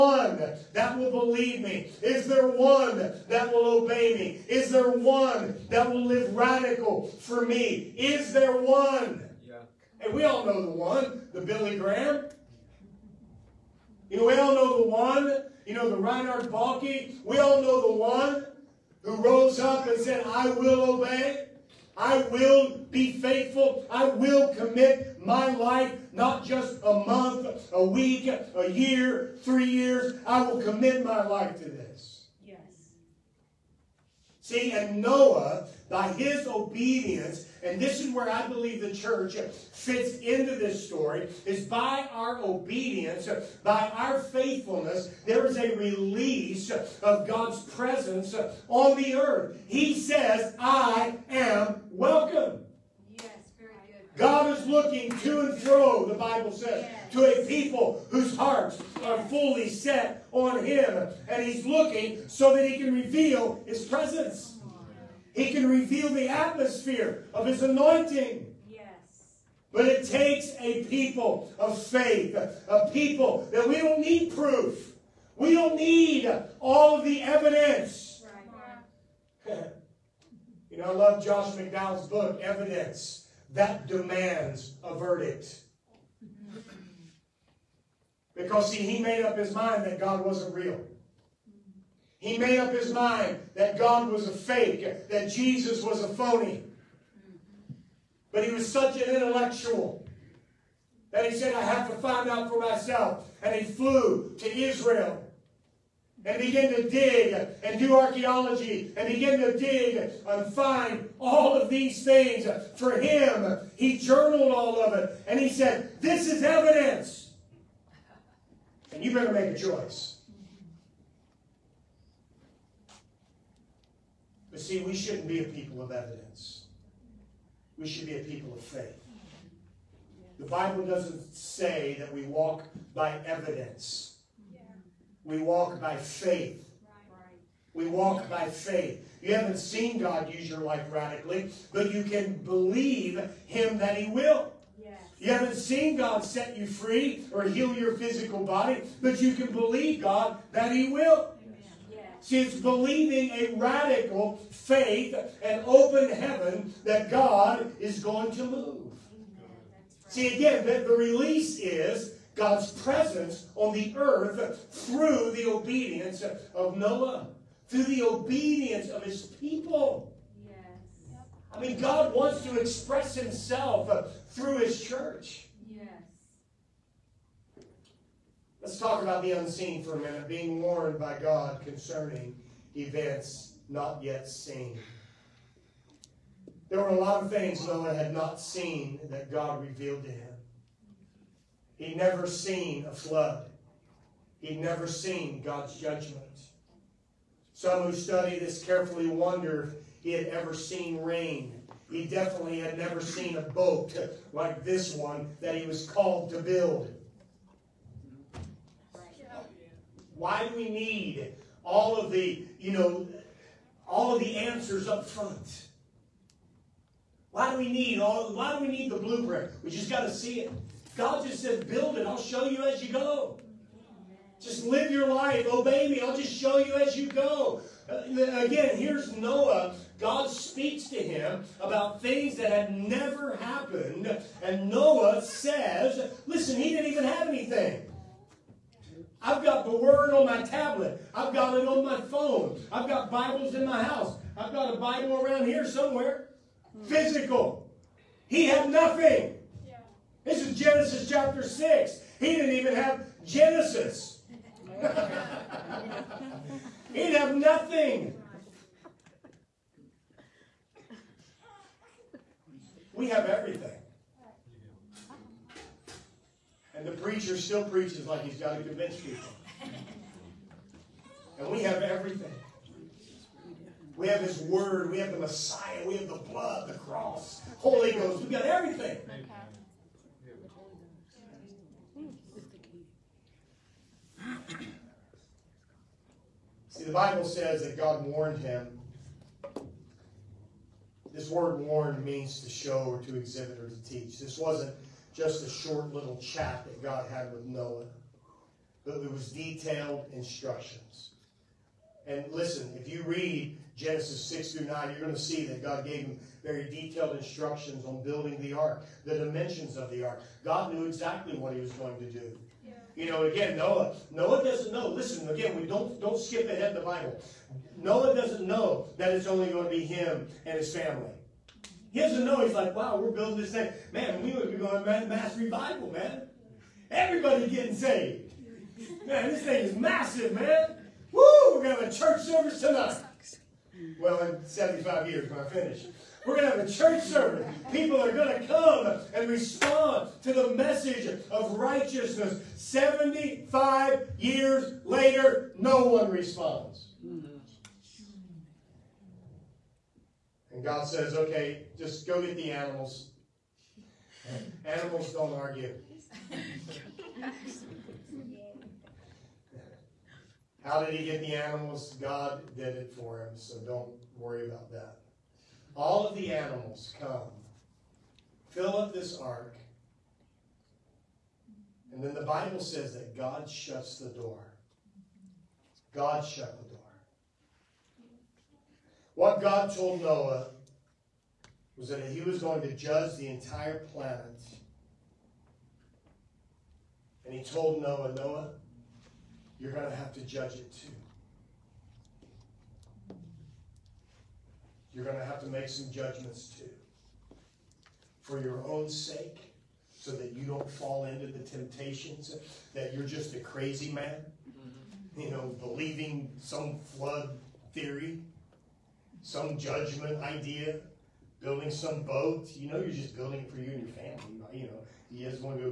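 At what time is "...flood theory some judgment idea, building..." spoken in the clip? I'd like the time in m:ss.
6:46.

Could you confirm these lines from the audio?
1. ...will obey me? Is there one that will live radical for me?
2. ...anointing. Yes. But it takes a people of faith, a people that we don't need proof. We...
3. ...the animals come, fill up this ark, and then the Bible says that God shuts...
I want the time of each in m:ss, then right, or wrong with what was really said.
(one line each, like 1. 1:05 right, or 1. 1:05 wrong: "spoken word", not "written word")
1. 0:03 right
2. 1:07 right
3. 6:06 right.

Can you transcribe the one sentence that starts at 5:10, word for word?
God knew exactly what he was going to do.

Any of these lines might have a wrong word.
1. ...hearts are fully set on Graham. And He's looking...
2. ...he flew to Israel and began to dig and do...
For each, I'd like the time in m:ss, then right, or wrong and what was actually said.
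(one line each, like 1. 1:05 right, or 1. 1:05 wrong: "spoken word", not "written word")
1. 0:58 wrong: "Him", not "Graham"
2. 1:43 right.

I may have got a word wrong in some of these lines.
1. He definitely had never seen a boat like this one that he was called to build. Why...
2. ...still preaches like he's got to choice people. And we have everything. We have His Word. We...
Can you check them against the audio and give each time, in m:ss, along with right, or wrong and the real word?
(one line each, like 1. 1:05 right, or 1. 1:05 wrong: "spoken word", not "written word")
1. 3:21 right
2. 4:27 wrong: "convince", not "choice".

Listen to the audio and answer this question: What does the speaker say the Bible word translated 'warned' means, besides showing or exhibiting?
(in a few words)
to teach.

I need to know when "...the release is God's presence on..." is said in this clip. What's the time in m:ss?
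2:40.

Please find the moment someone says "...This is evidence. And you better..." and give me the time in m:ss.
1:56.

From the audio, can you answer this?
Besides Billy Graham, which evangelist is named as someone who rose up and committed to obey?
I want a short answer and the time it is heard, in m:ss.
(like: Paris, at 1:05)
Reinhard Bonnke, at 0:15.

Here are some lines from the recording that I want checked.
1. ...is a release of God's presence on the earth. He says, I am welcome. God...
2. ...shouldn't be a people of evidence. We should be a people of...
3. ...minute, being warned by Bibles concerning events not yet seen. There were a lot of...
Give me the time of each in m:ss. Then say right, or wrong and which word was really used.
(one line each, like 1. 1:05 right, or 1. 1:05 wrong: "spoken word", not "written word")
1. 0:45 right
2. 2:04 right
3. 2:59 wrong: "God", not "Bibles".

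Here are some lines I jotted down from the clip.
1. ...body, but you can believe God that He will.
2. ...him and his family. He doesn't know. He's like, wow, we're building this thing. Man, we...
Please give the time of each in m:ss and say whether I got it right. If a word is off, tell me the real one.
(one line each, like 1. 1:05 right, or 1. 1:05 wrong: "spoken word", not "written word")
1. 2:28 right
2. 5:19 right.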